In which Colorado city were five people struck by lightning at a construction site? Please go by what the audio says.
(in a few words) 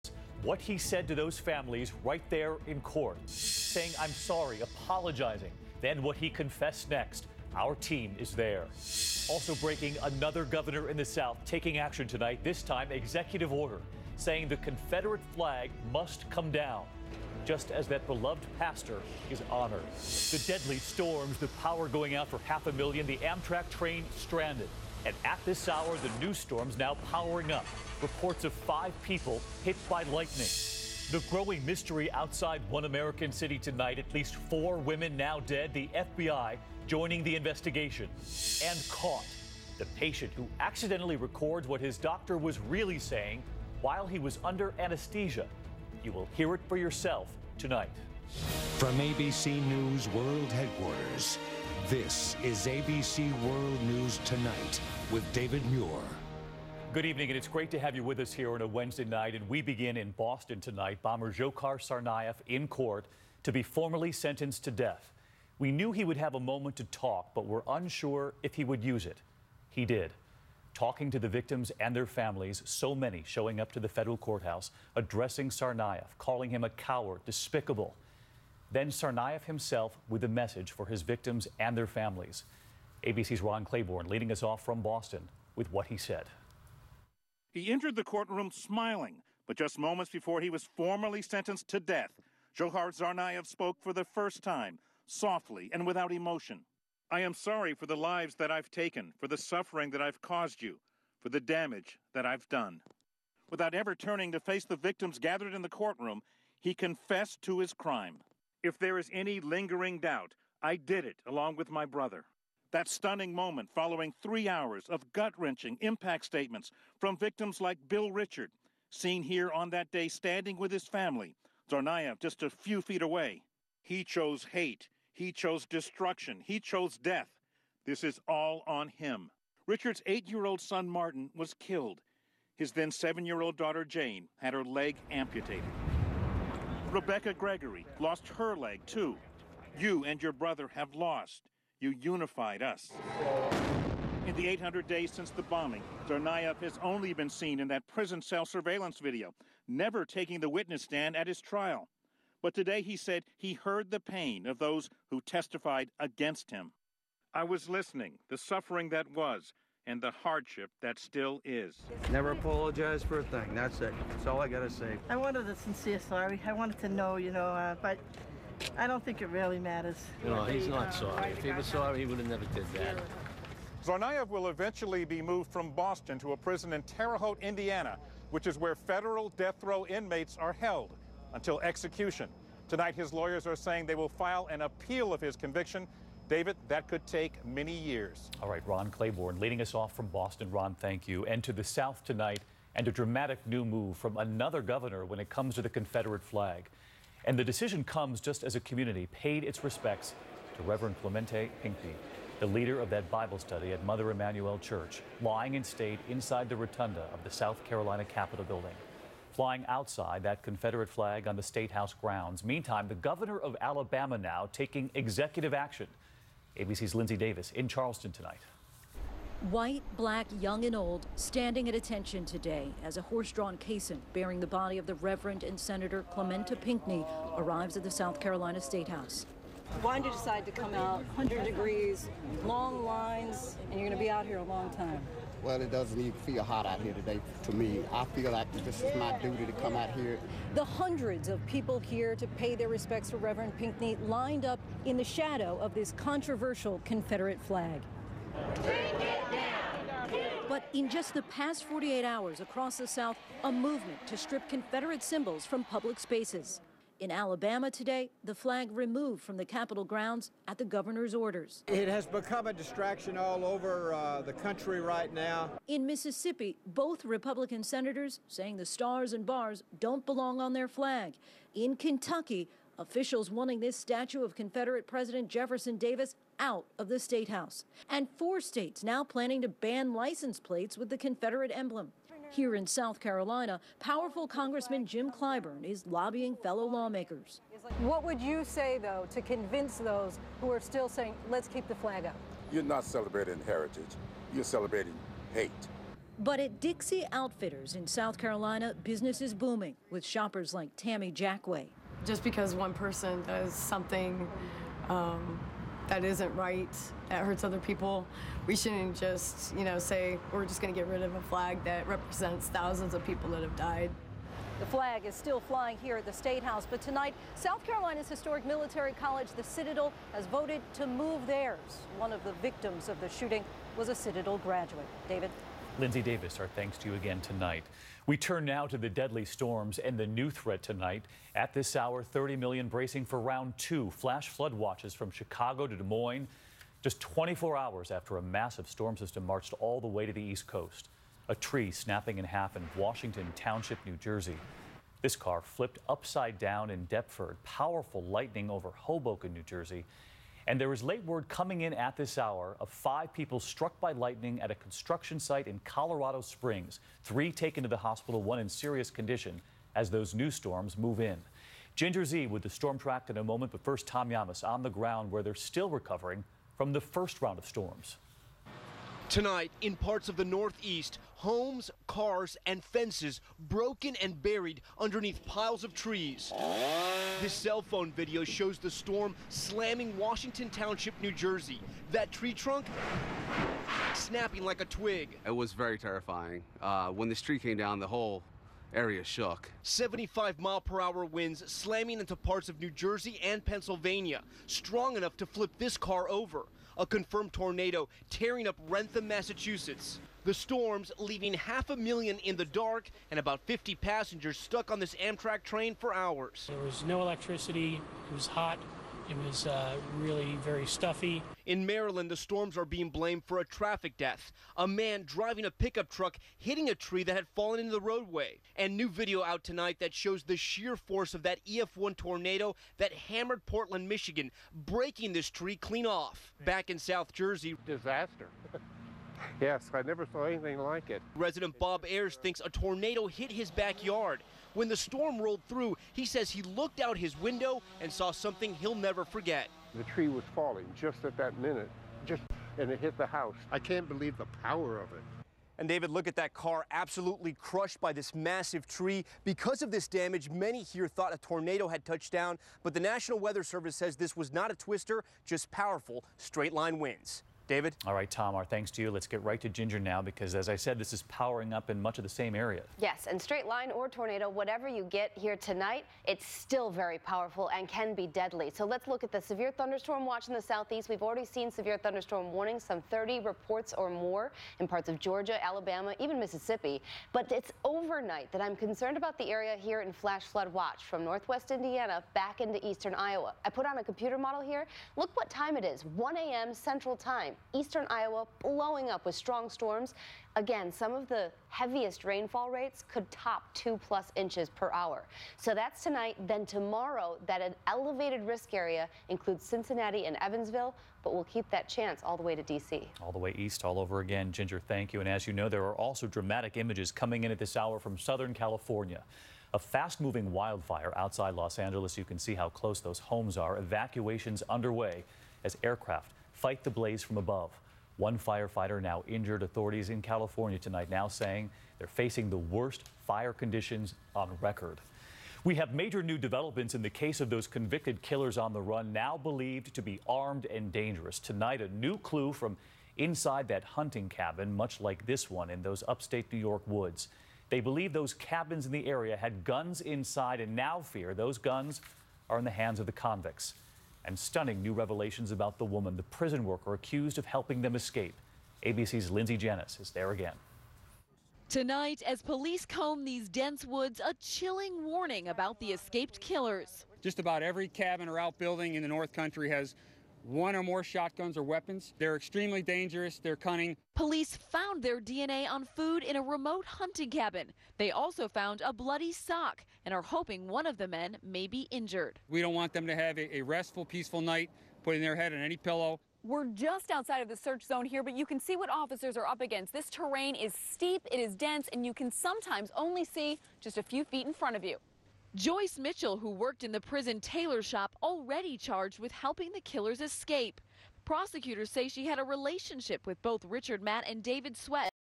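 Colorado Springs.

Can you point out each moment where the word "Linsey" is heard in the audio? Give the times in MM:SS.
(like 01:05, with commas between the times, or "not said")
03:36, 05:25, 09:09.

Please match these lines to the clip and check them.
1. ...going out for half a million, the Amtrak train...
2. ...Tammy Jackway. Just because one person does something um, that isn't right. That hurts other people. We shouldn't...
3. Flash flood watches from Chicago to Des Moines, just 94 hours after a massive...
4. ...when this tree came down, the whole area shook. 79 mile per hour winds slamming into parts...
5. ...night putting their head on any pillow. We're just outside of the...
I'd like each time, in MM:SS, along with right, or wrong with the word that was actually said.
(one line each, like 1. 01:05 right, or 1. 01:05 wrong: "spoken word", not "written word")
1. 00:21 right
2. 05:00 right
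3. 05:33 wrong: "24", not "94"
4. 06:26 wrong: "75", not "79"
5. 09:34 right.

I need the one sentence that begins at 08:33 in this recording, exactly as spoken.
Evacuations underway as aircraft fight the blaze from above.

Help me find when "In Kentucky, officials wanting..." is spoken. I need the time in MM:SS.
04:31.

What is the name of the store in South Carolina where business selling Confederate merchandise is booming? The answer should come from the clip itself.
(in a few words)
Dixie Outfitters.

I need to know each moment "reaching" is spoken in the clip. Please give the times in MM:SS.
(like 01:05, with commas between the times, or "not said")
not said.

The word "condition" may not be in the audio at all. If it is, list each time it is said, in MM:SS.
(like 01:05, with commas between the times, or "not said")
05:58, 08:43.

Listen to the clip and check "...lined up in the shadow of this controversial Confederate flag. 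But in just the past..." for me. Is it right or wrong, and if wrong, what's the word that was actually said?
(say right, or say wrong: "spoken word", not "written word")
right.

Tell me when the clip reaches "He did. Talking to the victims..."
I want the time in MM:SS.
01:09.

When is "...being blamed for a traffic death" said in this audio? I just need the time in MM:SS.
06:52.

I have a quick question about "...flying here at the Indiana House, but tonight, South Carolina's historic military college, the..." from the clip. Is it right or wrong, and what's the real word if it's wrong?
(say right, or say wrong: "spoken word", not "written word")
wrong: "State", not "Indiana".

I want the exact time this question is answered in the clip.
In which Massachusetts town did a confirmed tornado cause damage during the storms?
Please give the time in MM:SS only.
06:38.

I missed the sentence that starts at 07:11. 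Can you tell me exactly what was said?
Resident Bob Ayers thinks a tornado hit his backyard.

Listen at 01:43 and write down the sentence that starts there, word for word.
Without ever turning to face the victims gathered in the courtroom, he confessed to his crime.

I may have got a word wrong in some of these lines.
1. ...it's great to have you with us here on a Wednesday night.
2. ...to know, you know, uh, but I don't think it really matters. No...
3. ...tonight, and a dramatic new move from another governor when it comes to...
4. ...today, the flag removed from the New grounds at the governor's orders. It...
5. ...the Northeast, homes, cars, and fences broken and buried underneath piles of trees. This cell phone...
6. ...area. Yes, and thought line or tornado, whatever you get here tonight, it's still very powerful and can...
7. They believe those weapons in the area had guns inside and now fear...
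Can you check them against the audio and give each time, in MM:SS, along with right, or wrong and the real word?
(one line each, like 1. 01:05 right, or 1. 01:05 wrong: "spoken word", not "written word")
1. 00:57 right
2. 02:46 right
3. 03:12 right
4. 04:17 wrong: "Capitol", not "New"
5. 06:10 right
6. 07:42 wrong: "straight", not "thought"
7. 08:57 wrong: "cabins", not "weapons".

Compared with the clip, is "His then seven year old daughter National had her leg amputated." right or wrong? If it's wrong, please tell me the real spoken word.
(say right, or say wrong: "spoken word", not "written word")
wrong: "Jane", not "National".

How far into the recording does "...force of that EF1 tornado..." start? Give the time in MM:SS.
07:00.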